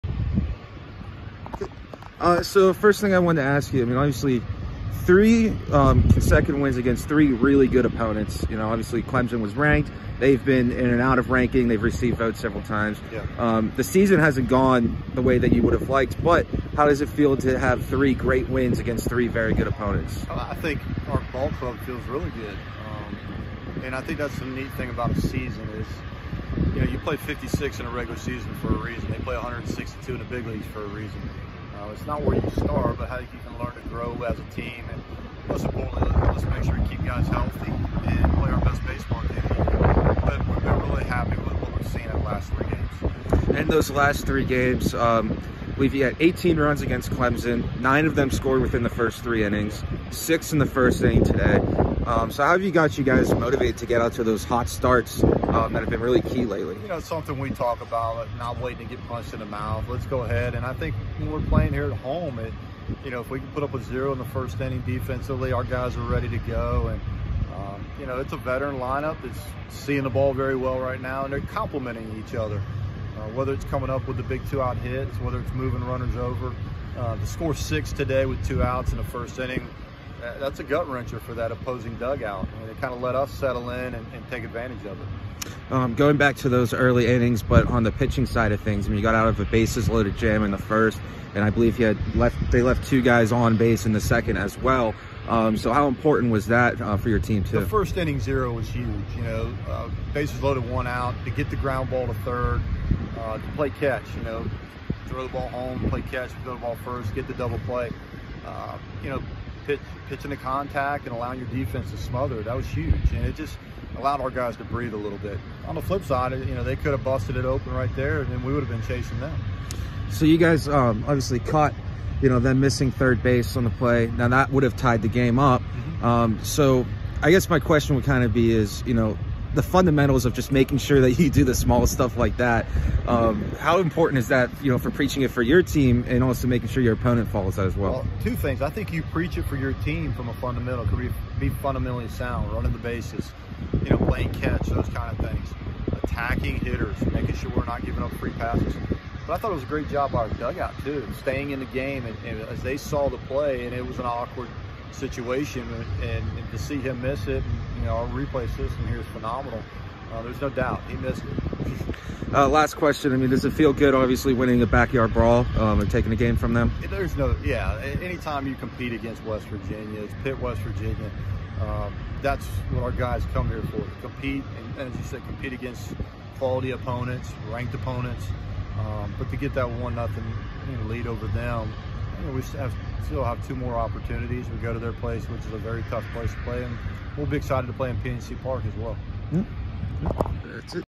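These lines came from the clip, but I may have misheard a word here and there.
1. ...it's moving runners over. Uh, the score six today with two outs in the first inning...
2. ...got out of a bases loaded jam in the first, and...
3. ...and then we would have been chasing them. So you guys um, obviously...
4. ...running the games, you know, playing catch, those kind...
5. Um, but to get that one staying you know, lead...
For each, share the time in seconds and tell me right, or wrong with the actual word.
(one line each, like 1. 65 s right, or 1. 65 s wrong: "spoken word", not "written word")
1. 75 s right
2. 89 s right
3. 118 s right
4. 142 s wrong: "bases", not "games"
5. 178 s wrong: "nothing", not "staying".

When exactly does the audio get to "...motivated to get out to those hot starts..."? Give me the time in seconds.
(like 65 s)
53 s.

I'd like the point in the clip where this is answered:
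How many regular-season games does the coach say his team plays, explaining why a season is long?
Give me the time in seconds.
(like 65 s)
27 s.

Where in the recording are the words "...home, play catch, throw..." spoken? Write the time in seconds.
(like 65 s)
105 s.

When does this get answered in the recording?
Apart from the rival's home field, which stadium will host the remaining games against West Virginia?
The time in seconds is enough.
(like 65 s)
187 s.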